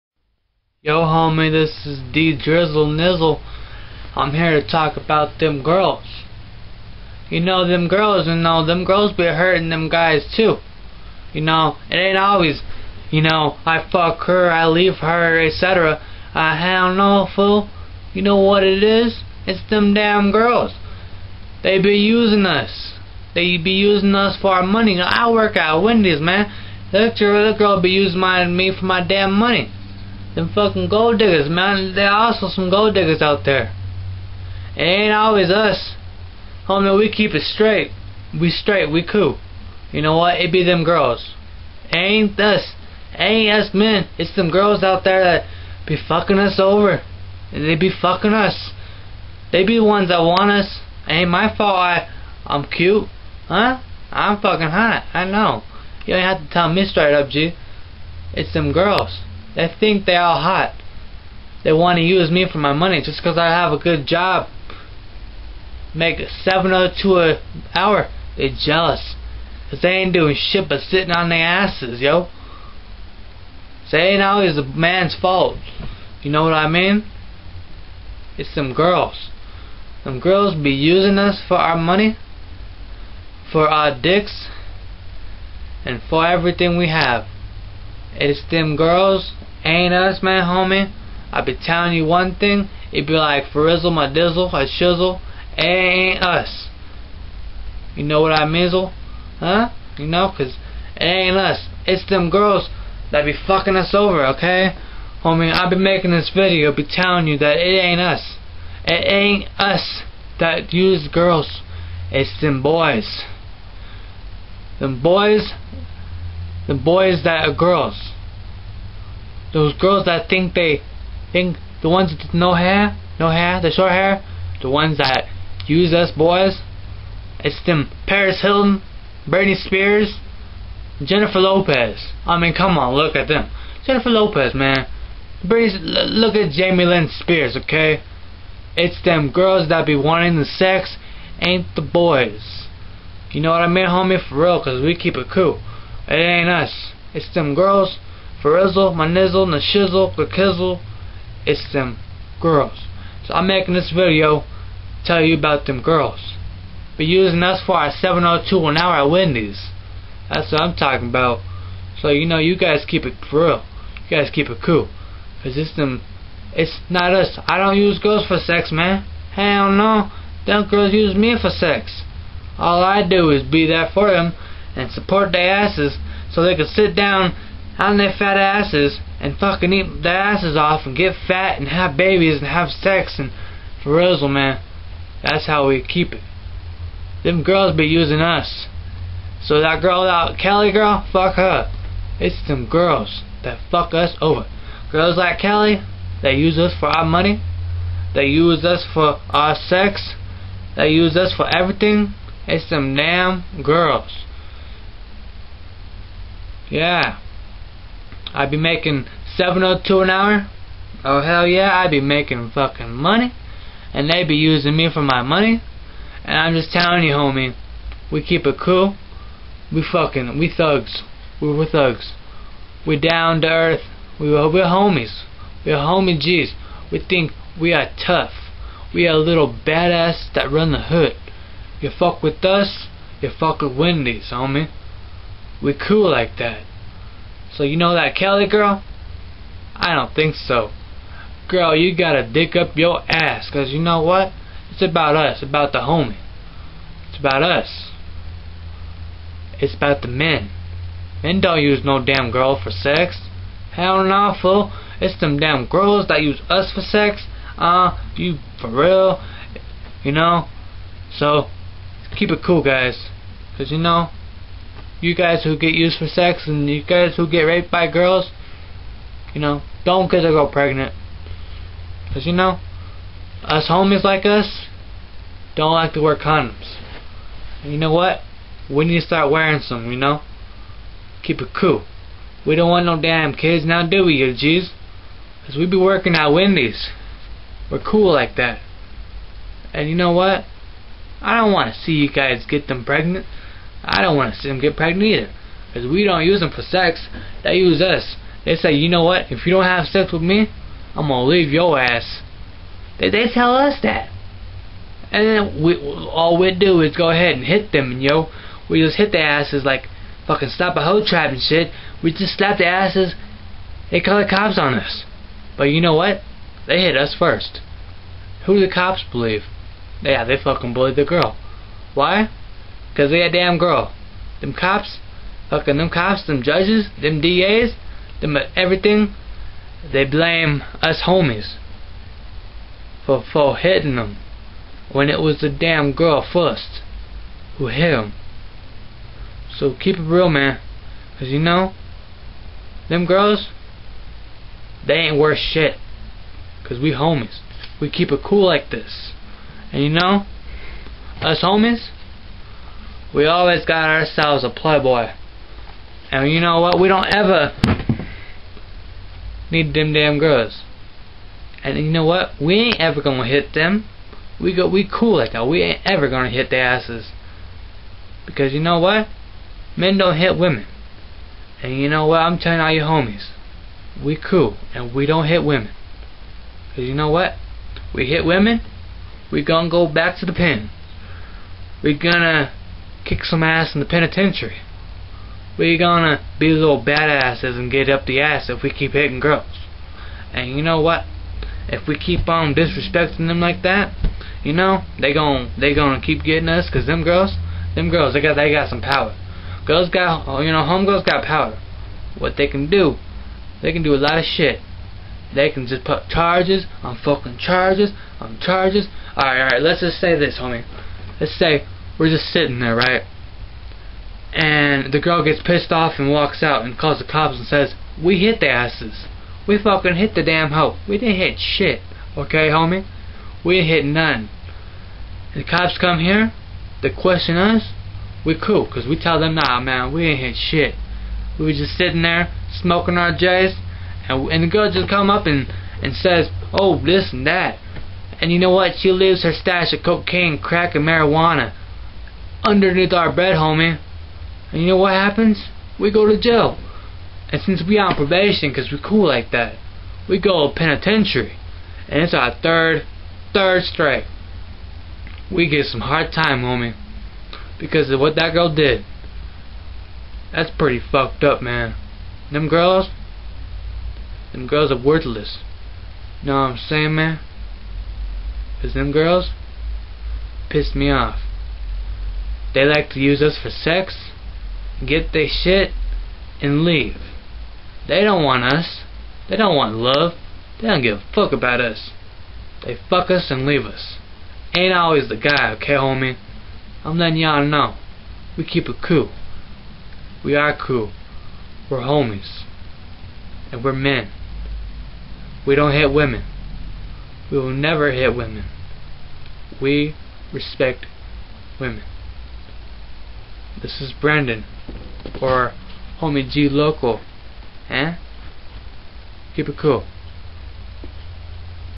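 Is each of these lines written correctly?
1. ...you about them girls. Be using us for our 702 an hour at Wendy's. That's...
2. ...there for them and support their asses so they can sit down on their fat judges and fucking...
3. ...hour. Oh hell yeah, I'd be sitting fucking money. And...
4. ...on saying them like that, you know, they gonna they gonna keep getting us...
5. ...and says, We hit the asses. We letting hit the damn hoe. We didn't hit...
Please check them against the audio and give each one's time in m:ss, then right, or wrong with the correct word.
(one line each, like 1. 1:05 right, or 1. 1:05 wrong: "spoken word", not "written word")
1. 2:35 right
2. 2:53 wrong: "asses", not "judges"
3. 3:30 wrong: "making", not "sitting"
4. 6:32 wrong: "disrespecting", not "saying"
5. 6:57 wrong: "fucking", not "letting".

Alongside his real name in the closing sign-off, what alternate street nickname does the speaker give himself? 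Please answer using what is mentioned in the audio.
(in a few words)
homie G Local.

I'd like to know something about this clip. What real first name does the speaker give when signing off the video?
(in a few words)
Brandon.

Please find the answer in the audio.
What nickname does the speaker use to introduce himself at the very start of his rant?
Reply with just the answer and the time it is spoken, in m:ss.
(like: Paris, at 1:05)
D Drizzle Nizzle, at 0:02.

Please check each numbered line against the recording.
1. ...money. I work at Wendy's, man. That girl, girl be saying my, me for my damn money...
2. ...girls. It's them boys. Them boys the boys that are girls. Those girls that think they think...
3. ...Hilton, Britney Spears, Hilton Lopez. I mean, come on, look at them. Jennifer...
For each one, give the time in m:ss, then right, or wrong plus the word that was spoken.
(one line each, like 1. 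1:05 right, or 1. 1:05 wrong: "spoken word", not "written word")
1. 0:24 wrong: "using", not "saying"
2. 1:51 right
3. 2:08 wrong: "Jennifer", not "Hilton".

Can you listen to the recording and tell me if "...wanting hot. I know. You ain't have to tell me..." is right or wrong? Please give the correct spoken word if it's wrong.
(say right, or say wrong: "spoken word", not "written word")
wrong: "fucking", not "wanting".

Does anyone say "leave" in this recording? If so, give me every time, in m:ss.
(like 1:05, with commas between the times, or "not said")
0:14, 5:01, 7:18, 7:56, 8:03.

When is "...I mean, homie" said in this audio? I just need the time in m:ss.
2:23.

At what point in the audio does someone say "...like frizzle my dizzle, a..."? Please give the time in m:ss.
1:33.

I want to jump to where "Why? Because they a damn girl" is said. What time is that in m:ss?
5:21.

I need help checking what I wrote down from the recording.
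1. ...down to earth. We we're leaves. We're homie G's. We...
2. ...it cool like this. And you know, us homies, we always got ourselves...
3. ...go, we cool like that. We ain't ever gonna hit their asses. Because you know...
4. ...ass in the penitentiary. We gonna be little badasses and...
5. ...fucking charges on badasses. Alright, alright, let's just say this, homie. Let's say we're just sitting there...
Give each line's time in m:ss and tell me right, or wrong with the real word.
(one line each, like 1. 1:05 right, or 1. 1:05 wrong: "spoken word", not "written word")
1. 3:42 wrong: "homies", not "leaves"
2. 5:48 right
3. 6:04 right
4. 6:23 right
5. 6:47 wrong: "charges", not "badasses".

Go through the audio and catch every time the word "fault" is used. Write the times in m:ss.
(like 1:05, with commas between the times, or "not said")
0:51, 1:15.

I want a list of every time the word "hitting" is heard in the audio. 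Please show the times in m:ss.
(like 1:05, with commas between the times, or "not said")
5:33, 6:28.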